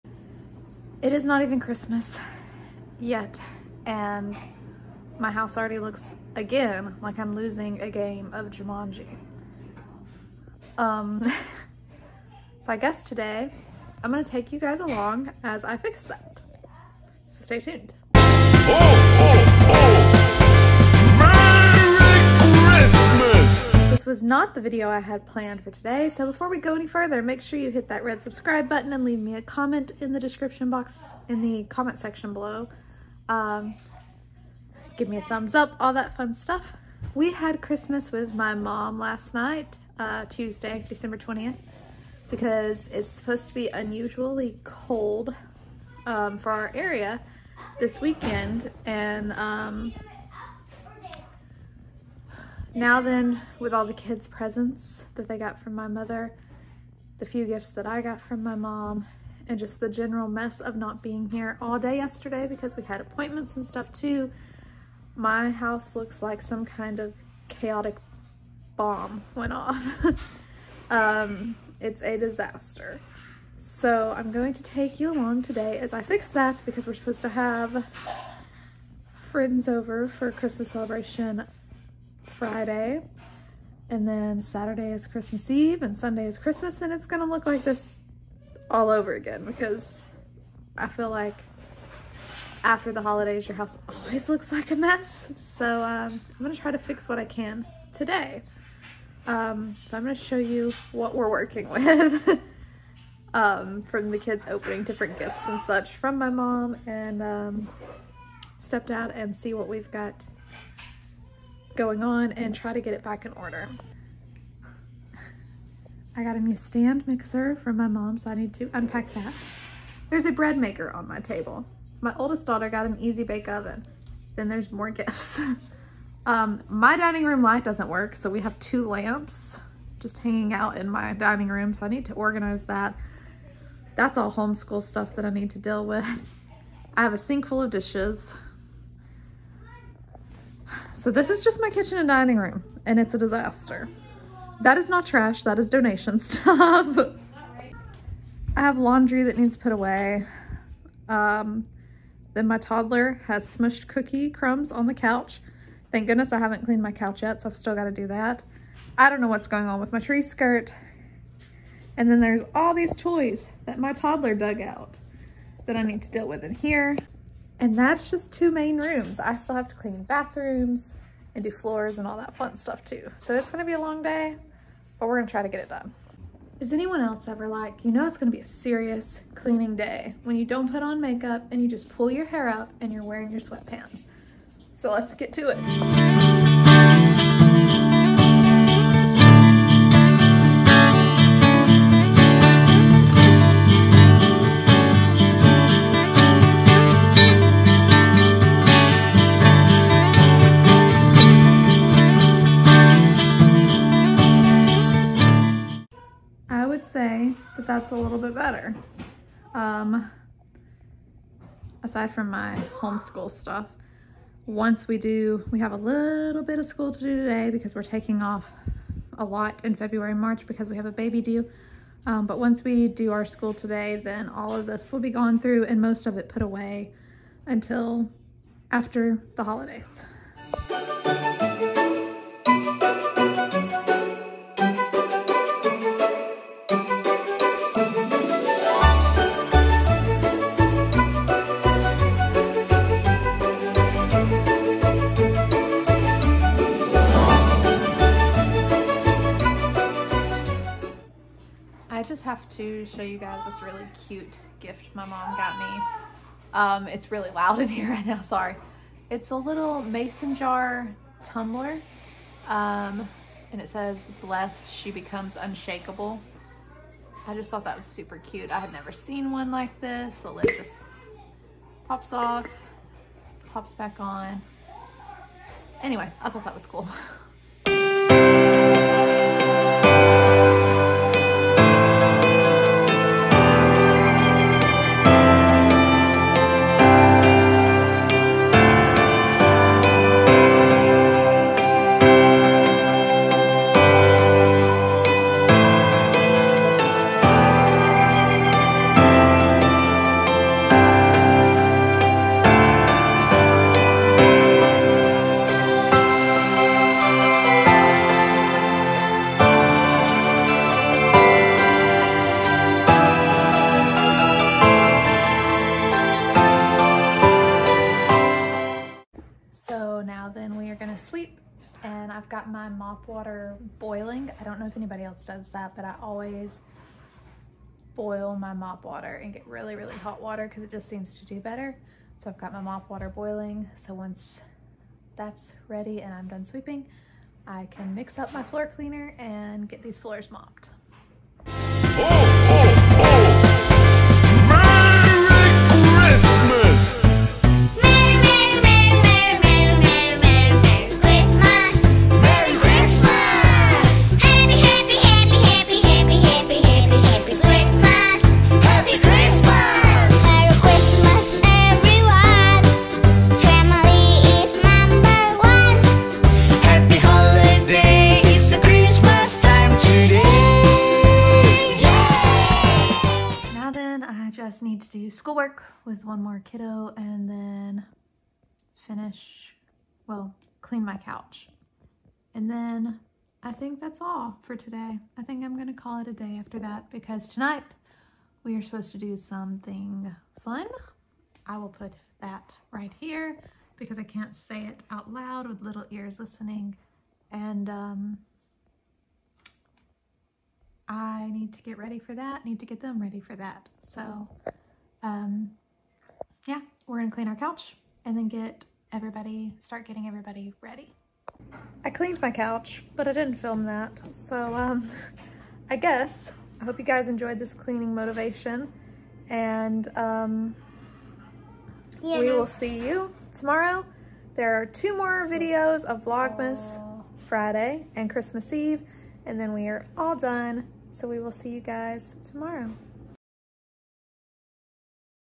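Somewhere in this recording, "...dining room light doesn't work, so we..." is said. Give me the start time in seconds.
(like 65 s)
126 s.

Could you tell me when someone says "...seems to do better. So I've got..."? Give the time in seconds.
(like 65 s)
330 s.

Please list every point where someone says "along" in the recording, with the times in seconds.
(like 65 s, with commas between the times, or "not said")
14 s, 75 s.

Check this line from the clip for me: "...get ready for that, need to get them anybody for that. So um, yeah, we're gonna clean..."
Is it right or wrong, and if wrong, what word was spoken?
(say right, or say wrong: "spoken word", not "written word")
wrong: "ready", not "anybody".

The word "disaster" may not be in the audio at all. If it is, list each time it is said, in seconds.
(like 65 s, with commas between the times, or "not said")
72 s, 143 s.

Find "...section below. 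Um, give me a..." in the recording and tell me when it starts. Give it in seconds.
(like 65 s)
31 s.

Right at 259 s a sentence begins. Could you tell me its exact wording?
It's a little mason jar tumbler.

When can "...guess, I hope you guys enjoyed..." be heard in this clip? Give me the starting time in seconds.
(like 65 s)
415 s.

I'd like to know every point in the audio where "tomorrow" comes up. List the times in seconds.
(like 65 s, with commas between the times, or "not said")
423 s, 432 s.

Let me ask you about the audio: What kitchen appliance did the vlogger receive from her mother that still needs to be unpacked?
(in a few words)
stand mixer.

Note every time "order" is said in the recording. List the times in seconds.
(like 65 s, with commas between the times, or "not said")
113 s.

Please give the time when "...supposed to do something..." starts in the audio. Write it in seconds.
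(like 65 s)
388 s.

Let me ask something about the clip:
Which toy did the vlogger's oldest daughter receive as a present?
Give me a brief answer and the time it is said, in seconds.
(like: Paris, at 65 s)
easy bake oven, at 122 s.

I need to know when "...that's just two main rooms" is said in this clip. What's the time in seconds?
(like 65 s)
167 s.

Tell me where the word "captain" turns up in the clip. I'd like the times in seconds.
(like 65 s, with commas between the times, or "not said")
not said.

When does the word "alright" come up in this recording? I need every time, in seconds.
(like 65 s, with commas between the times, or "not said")
not said.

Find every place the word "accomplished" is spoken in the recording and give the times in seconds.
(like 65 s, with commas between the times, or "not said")
not said.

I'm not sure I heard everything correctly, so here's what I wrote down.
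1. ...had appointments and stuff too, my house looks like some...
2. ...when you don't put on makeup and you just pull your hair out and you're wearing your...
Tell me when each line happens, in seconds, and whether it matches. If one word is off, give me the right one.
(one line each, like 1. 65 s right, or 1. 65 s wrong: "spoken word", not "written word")
1. 62 s right
2. 180 s right.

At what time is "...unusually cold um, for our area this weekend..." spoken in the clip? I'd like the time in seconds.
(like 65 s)
43 s.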